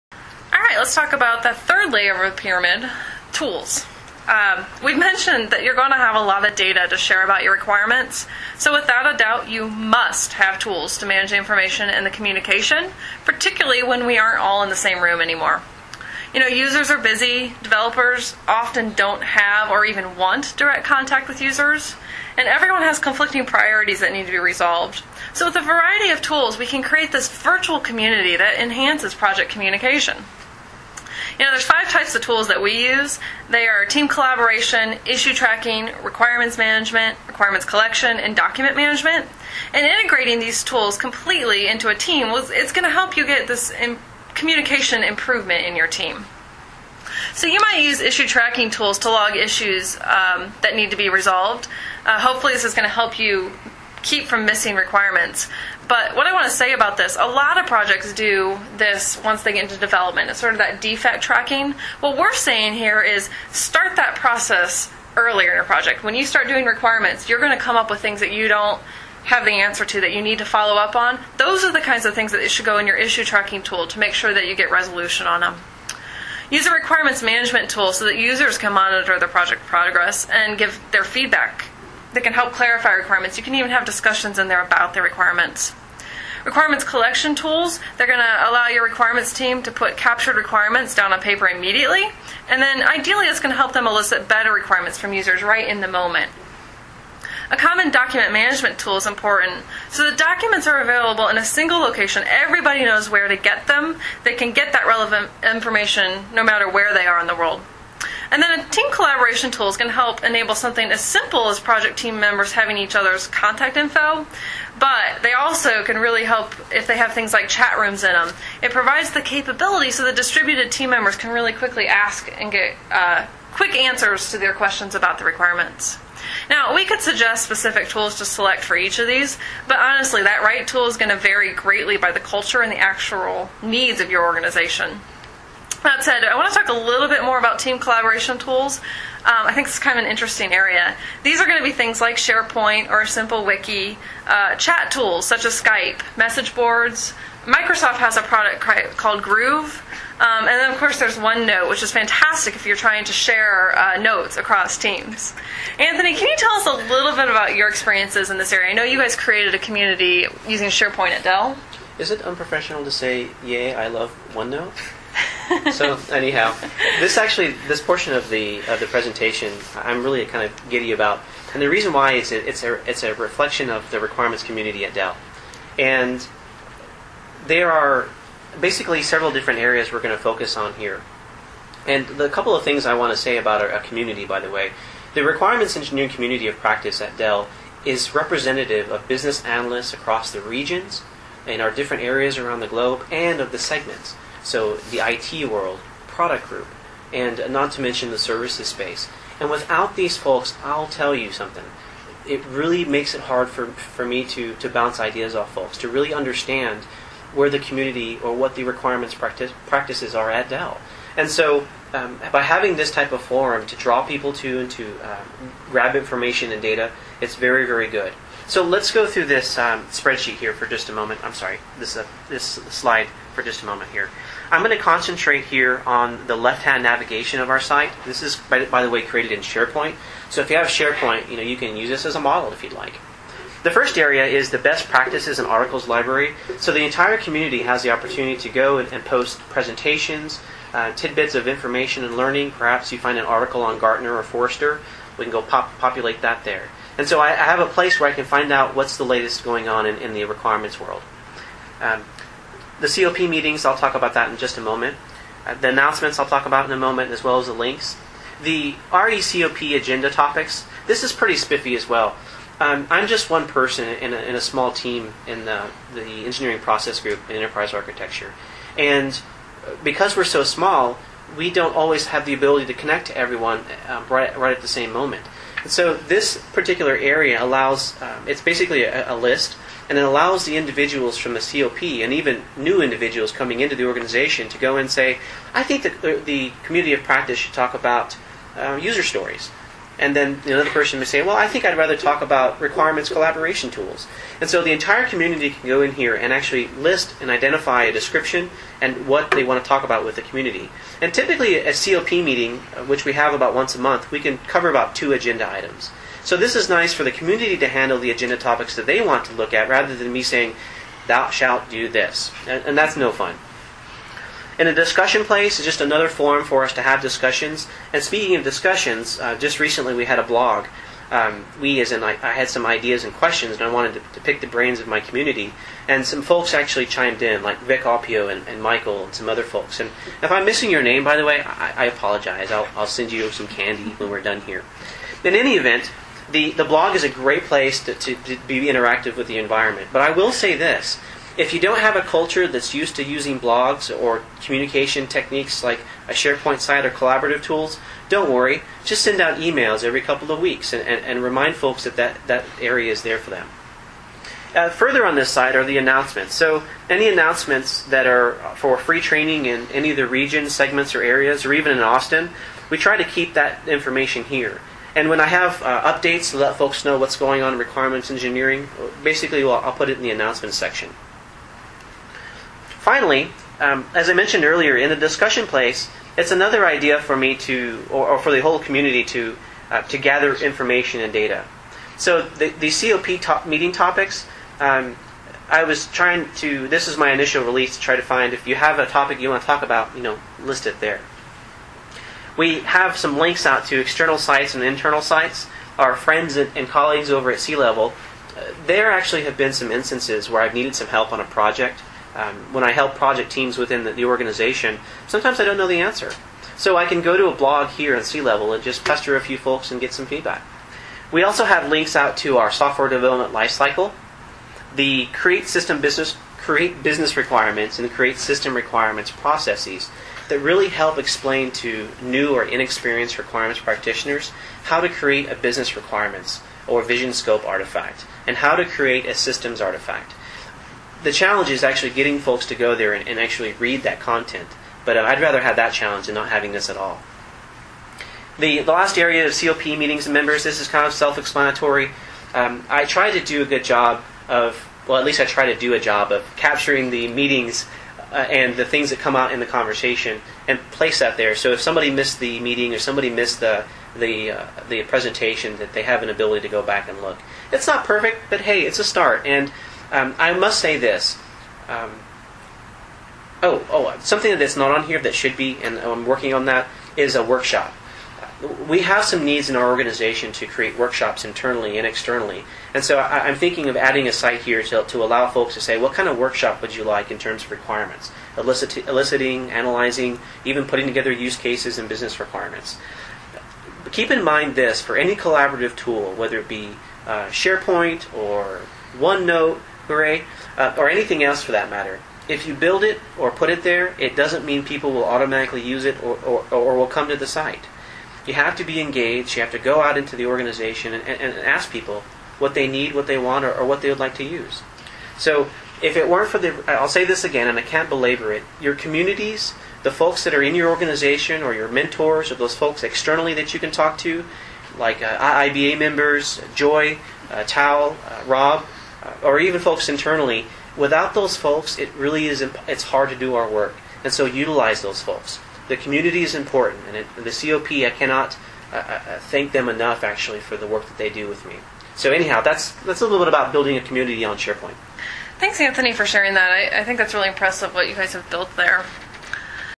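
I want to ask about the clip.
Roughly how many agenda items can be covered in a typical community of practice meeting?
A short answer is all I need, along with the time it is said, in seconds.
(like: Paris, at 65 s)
2, at 304 s.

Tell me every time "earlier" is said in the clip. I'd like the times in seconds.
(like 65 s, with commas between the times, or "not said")
65 s, 374 s.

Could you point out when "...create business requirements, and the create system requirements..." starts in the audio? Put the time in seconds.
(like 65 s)
416 s.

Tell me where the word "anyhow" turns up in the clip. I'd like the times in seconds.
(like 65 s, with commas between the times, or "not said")
166 s, 532 s.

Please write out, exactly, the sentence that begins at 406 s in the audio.
So I can go to a blog here in Seilevel and just pester a few folks and get some feedback.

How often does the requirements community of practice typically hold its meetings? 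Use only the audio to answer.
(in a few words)
Once a month.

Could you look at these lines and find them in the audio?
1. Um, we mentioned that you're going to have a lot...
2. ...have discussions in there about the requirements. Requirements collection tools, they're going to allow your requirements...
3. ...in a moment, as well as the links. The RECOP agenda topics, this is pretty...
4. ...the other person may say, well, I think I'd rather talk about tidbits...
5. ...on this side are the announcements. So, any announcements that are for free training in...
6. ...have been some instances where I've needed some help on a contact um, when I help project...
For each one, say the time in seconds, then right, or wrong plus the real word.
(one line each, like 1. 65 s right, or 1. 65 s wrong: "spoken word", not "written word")
1. 4 s right
2. 83 s right
3. 256 s right
4. 290 s wrong: "requirements", not "tidbits"
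5. 355 s right
6. 399 s wrong: "project", not "contact".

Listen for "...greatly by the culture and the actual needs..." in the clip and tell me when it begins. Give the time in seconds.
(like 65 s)
131 s.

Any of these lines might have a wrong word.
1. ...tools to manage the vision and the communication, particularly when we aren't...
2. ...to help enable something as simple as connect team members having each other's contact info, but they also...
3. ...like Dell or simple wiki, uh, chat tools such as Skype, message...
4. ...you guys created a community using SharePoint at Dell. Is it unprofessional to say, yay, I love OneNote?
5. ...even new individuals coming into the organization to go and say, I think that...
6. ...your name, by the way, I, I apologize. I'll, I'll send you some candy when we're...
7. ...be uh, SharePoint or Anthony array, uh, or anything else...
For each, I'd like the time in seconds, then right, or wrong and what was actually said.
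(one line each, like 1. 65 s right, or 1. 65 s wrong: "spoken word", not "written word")
1. 10 s wrong: "information", not "vision"
2. 109 s wrong: "project", not "connect"
3. 141 s wrong: "SharePoint", not "Dell"
4. 158 s right
5. 282 s right
6. 330 s right
7. 486 s wrong: "OneNote", not "Anthony".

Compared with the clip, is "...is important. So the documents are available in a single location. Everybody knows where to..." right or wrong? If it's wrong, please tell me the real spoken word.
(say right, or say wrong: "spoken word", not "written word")
right.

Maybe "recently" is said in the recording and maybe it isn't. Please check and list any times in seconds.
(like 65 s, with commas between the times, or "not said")
319 s.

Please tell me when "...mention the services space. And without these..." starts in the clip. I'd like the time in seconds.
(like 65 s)
197 s.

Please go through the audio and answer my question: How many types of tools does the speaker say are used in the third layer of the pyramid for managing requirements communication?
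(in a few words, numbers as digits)
5.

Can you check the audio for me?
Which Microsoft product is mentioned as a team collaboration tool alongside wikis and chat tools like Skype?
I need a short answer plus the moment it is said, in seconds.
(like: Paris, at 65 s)
Groove, at 149 s.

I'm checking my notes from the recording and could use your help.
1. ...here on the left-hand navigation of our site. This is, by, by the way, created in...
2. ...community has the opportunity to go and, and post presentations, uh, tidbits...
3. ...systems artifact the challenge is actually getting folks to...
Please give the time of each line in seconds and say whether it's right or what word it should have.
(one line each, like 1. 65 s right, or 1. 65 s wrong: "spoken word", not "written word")
1. 225 s right
2. 237 s right
3. 429 s right.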